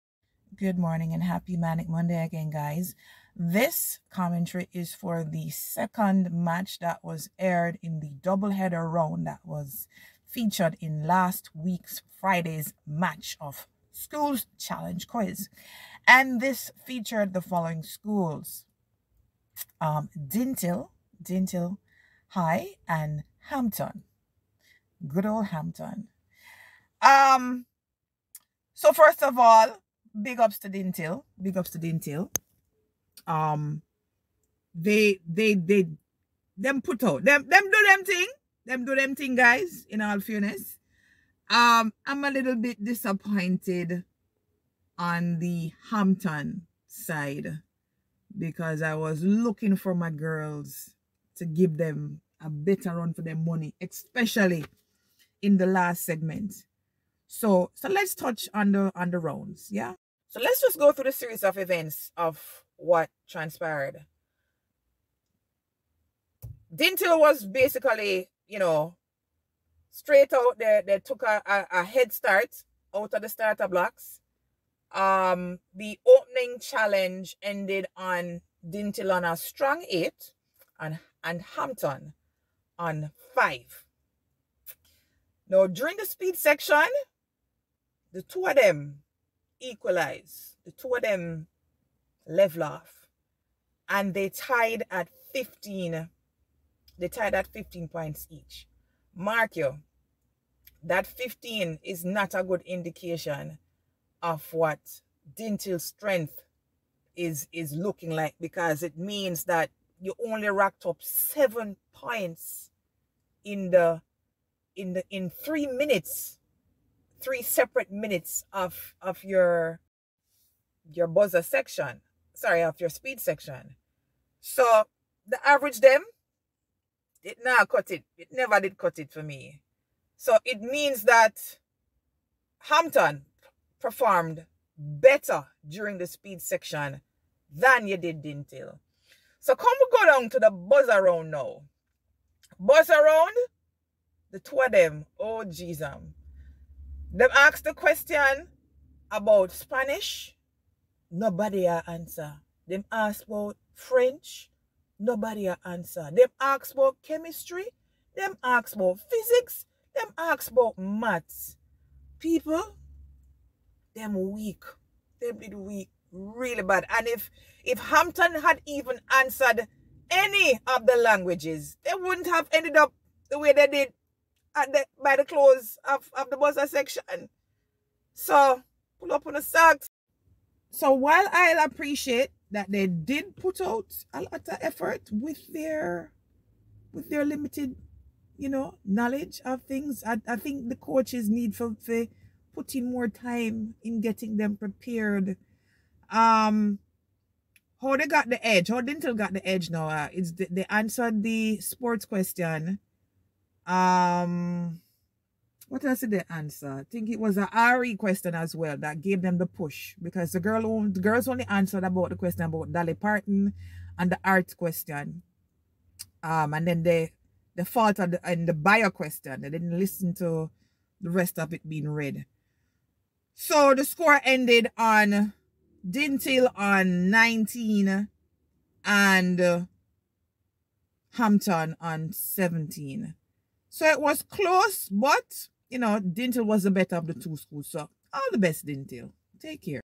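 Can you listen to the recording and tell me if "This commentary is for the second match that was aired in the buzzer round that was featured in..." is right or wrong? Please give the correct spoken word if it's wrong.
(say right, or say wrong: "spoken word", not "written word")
wrong: "doubleheader", not "buzzer".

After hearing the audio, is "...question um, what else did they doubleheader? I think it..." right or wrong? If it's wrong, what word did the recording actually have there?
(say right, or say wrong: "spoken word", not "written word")
wrong: "answer", not "doubleheader".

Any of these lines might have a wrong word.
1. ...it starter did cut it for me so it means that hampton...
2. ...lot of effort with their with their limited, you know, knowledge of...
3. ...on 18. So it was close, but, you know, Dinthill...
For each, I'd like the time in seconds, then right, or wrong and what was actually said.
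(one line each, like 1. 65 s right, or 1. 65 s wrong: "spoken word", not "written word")
1. 128 s wrong: "never", not "starter"
2. 184 s right
3. 231 s wrong: "17", not "18".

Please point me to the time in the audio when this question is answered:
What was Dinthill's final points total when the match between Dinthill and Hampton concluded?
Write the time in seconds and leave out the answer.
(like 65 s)
225 s.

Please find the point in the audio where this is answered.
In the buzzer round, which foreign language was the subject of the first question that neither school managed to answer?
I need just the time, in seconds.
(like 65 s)
149 s.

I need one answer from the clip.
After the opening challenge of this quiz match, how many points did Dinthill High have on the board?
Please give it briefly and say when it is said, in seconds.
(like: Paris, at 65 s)
8, at 79 s.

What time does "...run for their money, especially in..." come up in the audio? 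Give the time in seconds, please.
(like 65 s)
52 s.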